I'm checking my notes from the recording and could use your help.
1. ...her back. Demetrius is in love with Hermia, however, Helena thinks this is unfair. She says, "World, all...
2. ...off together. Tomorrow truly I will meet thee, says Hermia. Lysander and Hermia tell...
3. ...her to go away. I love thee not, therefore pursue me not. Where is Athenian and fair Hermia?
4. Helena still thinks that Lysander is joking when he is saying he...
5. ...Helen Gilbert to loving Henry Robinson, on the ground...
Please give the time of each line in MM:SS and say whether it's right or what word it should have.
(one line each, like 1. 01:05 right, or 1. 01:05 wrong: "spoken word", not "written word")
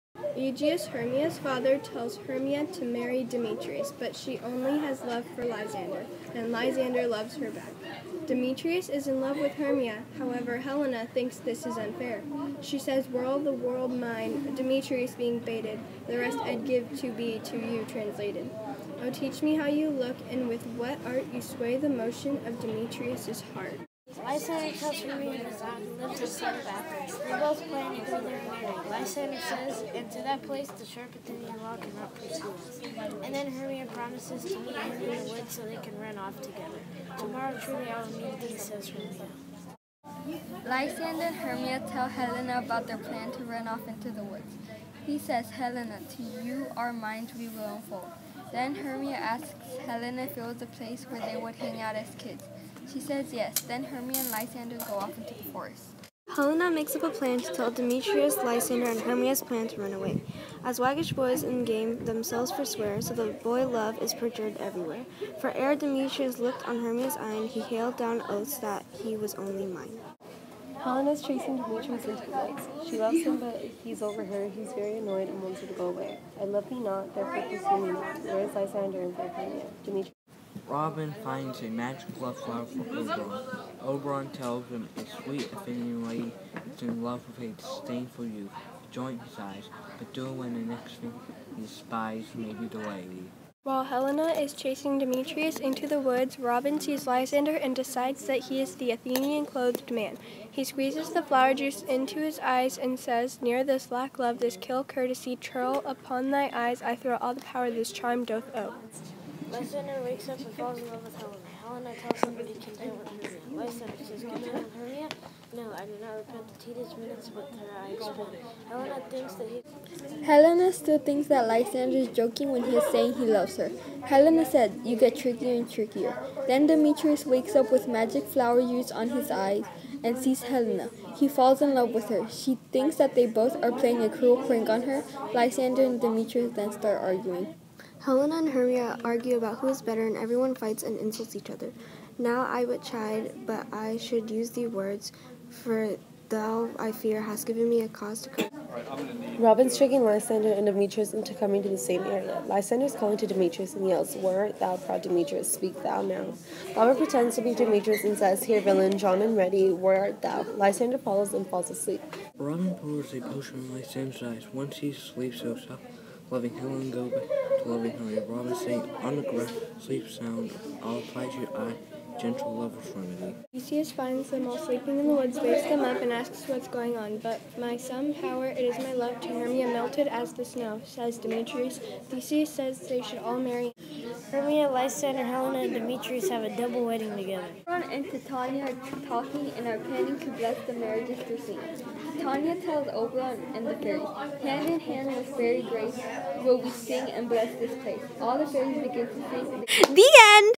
1. 00:07 right
2. 00:36 right
3. 01:15 wrong: "Lysander", not "Athenian"
4. 02:00 right
5. 02:46 right.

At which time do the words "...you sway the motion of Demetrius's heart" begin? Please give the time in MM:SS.
00:21.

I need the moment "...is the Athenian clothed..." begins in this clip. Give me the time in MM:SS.
01:38.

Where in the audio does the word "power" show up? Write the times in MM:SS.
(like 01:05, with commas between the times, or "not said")
01:47, 02:58.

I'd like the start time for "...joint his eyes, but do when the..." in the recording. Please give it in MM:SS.
01:28.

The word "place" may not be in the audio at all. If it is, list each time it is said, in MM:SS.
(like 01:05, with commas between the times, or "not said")
00:30, 00:50, 03:17.